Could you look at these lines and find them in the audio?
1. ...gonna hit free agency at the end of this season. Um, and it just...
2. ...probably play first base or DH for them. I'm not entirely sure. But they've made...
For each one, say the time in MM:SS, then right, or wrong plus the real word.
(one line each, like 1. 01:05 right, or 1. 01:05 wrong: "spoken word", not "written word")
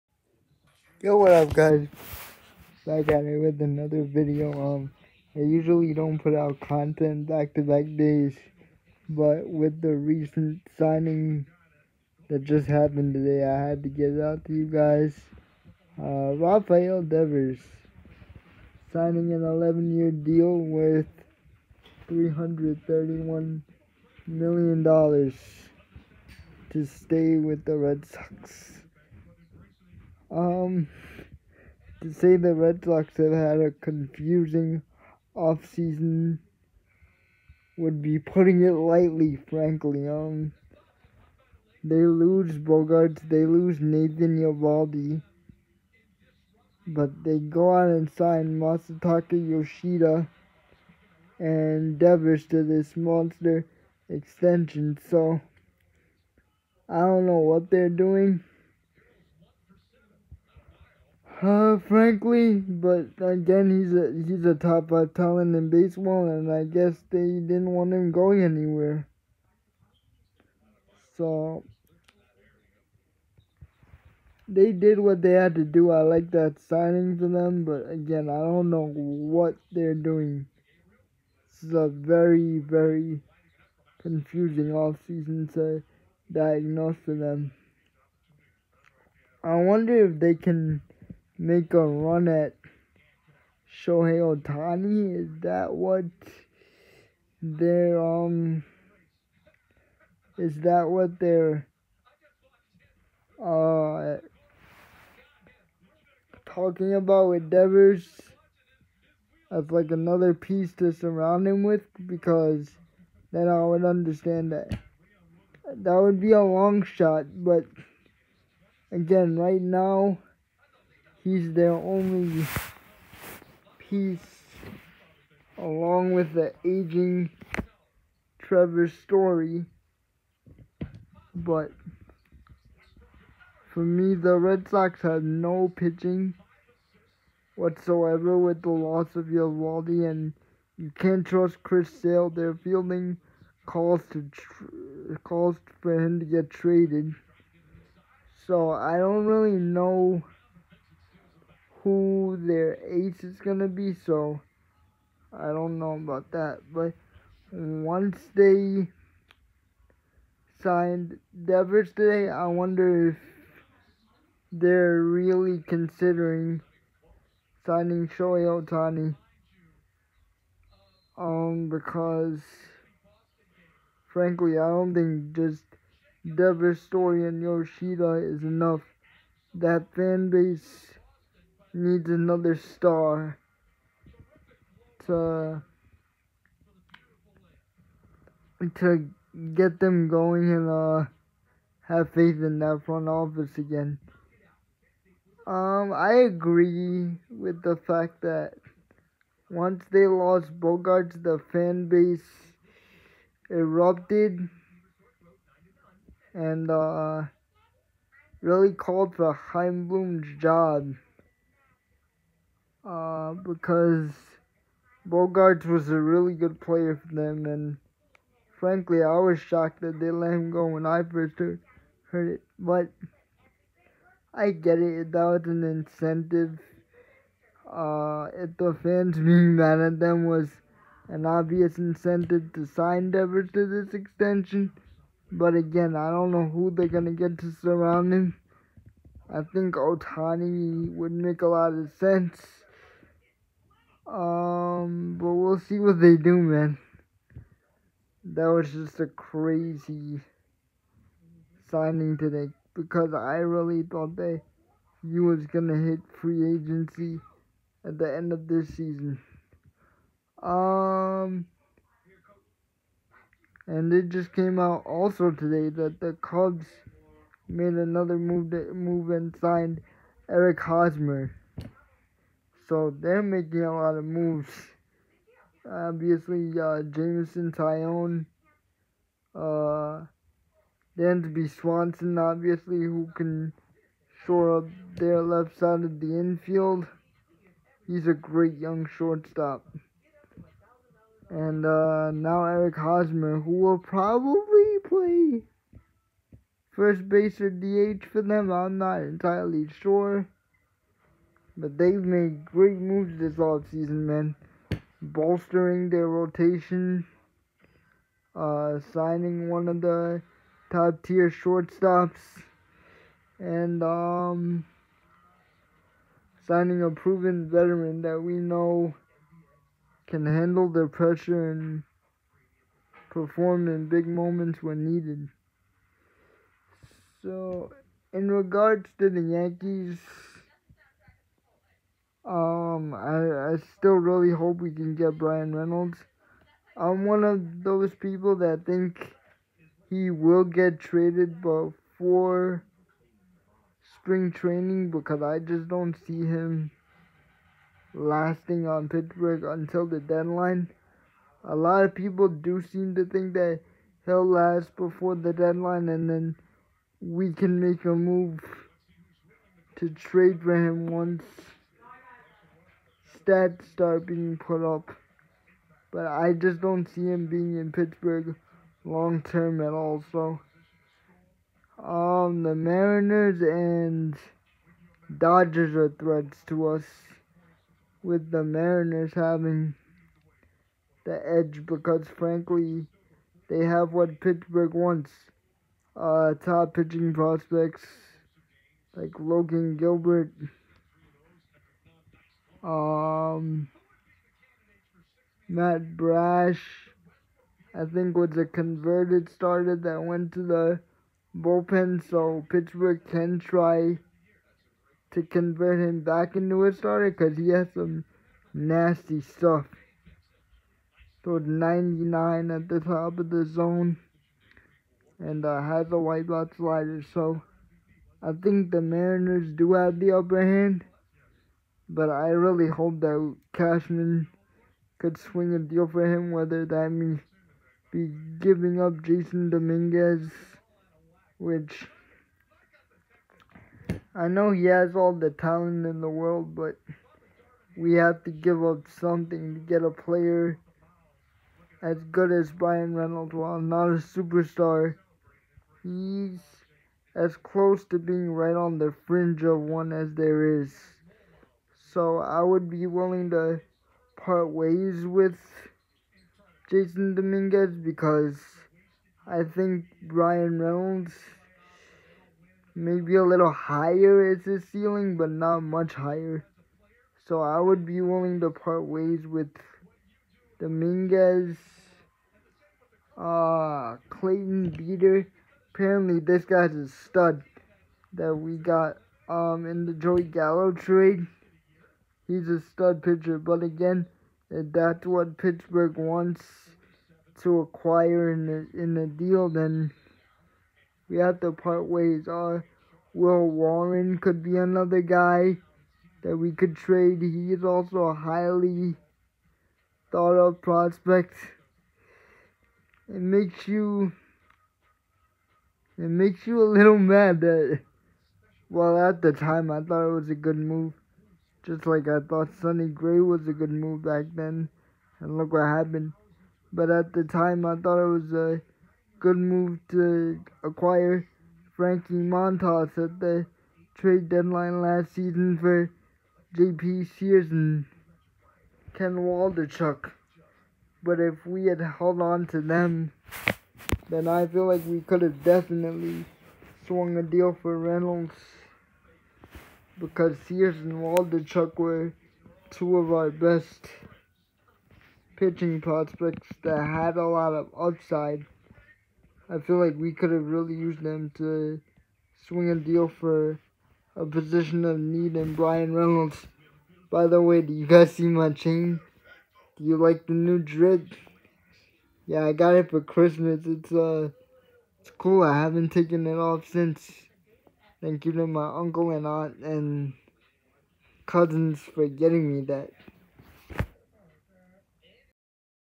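1. 04:15 right
2. 04:53 right.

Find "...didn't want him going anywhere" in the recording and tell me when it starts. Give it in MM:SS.
01:07.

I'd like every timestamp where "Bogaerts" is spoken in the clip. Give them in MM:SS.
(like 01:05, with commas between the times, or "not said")
00:42, 03:20, 03:35.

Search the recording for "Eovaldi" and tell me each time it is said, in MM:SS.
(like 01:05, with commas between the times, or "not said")
00:44, 02:19.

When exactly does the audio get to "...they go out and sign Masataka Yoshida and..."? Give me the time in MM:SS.
00:47.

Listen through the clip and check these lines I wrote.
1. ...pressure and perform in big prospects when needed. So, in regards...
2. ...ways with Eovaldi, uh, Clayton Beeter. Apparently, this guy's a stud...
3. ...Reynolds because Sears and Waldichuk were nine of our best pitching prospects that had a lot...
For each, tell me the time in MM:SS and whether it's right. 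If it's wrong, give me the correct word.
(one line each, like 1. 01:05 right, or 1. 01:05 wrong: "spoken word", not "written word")
1. 05:20 wrong: "moments", not "prospects"
2. 07:48 wrong: "Dominguez", not "Eovaldi"
3. 08:57 wrong: "two", not "nine".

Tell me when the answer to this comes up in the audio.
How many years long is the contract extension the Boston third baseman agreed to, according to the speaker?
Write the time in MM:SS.
00:19.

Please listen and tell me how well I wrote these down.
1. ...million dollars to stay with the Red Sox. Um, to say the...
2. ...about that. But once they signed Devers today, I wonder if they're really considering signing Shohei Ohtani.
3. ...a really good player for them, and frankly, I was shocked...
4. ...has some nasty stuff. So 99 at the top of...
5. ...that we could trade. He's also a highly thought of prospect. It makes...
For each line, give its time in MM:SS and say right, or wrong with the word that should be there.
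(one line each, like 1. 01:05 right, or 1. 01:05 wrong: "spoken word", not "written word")
1. 00:24 right
2. 02:35 right
3. 03:35 right
4. 06:47 right
5. 08:16 right.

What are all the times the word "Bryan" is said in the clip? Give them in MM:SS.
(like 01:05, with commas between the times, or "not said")
05:35, 07:22, 07:40, 09:15.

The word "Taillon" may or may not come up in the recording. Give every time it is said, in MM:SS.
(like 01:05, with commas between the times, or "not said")
04:37.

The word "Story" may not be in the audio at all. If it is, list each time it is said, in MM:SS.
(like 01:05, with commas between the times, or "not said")
02:08, 02:56.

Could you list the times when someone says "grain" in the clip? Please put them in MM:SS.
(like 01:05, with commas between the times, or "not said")
not said.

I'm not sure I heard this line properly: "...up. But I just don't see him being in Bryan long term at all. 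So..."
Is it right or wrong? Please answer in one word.
wrong.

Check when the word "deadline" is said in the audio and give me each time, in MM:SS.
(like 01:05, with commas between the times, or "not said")
05:49, 05:55, 08:44.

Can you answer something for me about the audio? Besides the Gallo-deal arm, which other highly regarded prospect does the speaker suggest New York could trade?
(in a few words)
Will Warren.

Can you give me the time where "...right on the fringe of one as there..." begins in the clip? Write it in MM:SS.
07:28.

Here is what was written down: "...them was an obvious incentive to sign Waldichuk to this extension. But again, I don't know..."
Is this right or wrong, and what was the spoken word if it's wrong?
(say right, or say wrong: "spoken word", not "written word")
wrong: "Devers", not "Waldichuk".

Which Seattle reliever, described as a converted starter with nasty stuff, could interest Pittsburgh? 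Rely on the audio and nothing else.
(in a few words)
Matt Brash.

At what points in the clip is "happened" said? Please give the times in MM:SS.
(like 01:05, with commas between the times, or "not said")
00:12, 08:35.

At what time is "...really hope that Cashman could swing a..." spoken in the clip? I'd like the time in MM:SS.
07:02.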